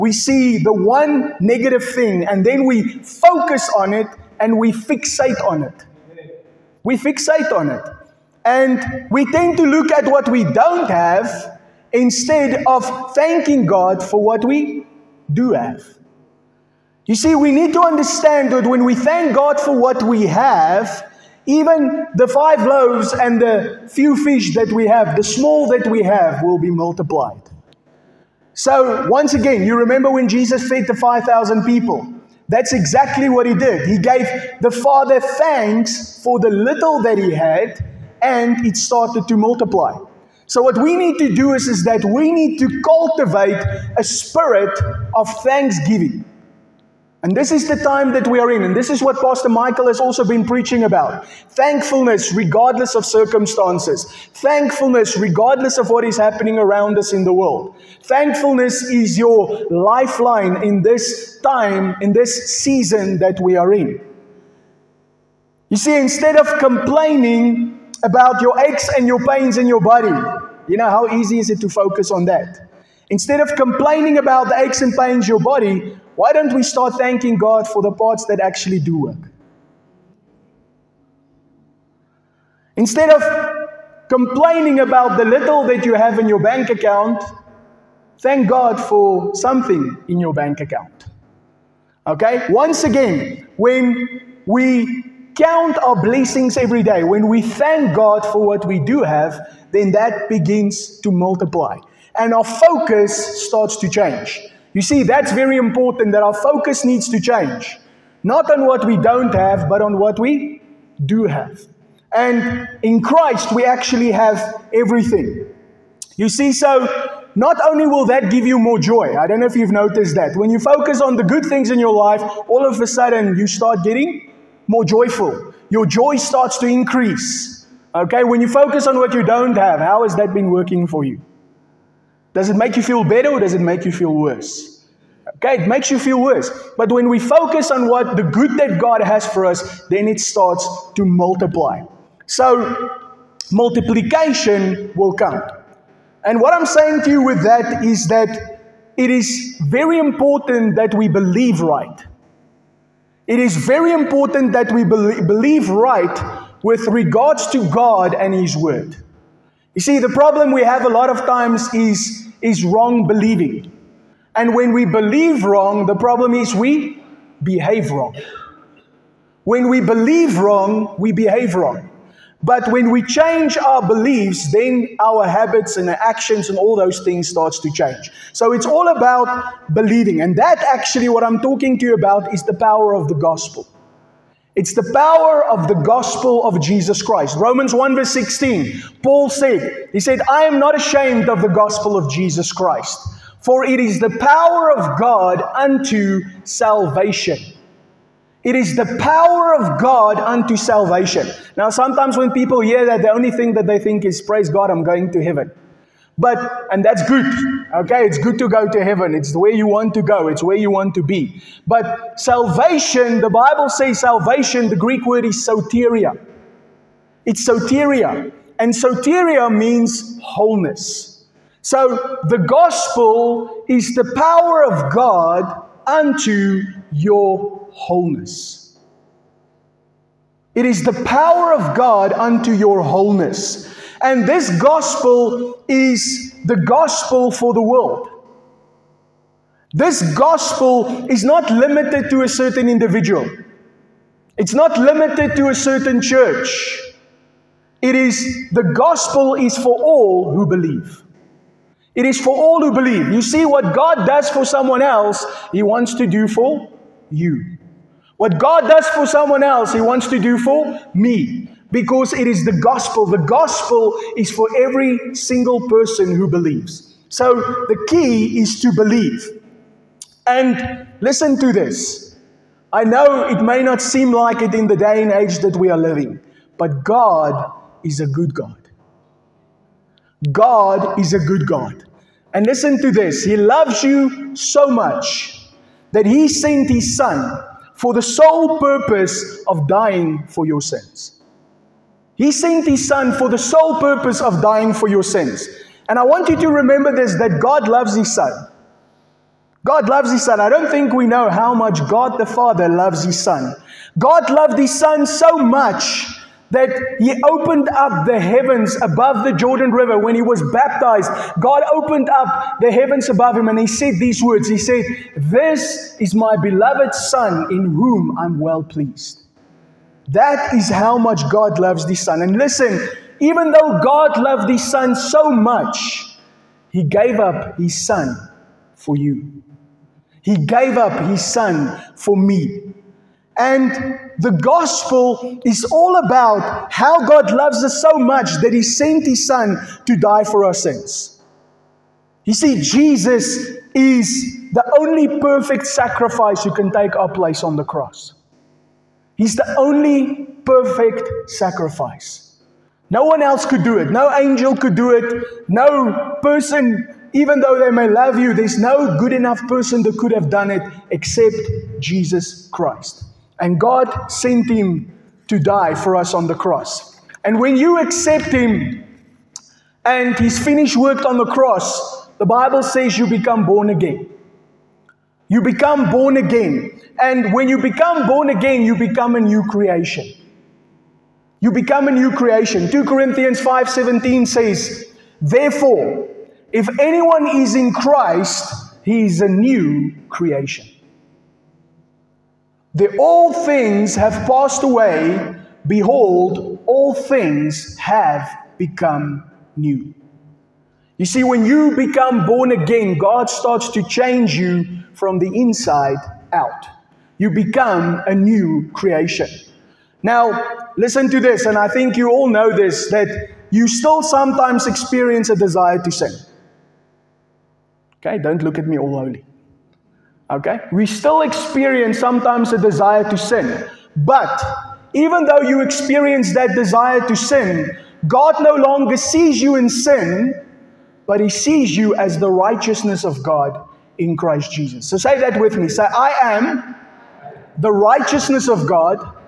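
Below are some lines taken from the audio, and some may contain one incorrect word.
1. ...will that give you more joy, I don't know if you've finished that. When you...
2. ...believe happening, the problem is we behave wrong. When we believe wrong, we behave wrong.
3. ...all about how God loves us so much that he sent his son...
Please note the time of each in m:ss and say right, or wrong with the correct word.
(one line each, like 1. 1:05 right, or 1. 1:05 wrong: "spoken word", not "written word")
1. 1:57 wrong: "noticed", not "finished"
2. 2:44 wrong: "wrong", not "happening"
3. 5:35 right.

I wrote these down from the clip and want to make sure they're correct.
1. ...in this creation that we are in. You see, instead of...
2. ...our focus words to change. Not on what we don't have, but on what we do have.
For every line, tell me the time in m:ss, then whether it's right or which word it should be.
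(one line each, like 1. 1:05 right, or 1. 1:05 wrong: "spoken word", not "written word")
1. 1:02 wrong: "season", not "creation"
2. 1:46 wrong: "needs", not "words".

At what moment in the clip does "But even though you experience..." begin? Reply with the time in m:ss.
7:03.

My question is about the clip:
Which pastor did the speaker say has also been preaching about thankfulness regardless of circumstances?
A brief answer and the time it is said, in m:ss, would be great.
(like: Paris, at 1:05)
Pastor Michael, at 0:49.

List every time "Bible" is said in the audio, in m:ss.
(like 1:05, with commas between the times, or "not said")
3:33, 6:12.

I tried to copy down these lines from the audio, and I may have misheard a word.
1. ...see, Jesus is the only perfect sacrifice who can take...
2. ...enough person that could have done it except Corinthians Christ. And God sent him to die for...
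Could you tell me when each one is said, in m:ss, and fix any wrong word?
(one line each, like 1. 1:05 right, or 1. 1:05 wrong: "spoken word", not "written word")
1. 5:42 right
2. 5:59 wrong: "Jesus", not "Corinthians".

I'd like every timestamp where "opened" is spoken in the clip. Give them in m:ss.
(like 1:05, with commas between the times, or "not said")
5:07, 5:11.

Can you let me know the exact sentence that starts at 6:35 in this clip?
Behold, all things have become new.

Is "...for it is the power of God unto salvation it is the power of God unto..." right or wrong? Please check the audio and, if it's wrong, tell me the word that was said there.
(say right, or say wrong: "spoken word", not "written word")
right.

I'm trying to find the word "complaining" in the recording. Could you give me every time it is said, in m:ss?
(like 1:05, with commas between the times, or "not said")
1:06, 1:13, 1:24.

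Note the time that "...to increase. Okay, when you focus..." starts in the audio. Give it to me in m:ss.
2:06.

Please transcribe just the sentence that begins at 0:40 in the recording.
So what we need to do is, is that we need to cultivate a spirit of thanksgiving.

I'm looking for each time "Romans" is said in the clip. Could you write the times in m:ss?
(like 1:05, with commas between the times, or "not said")
3:07.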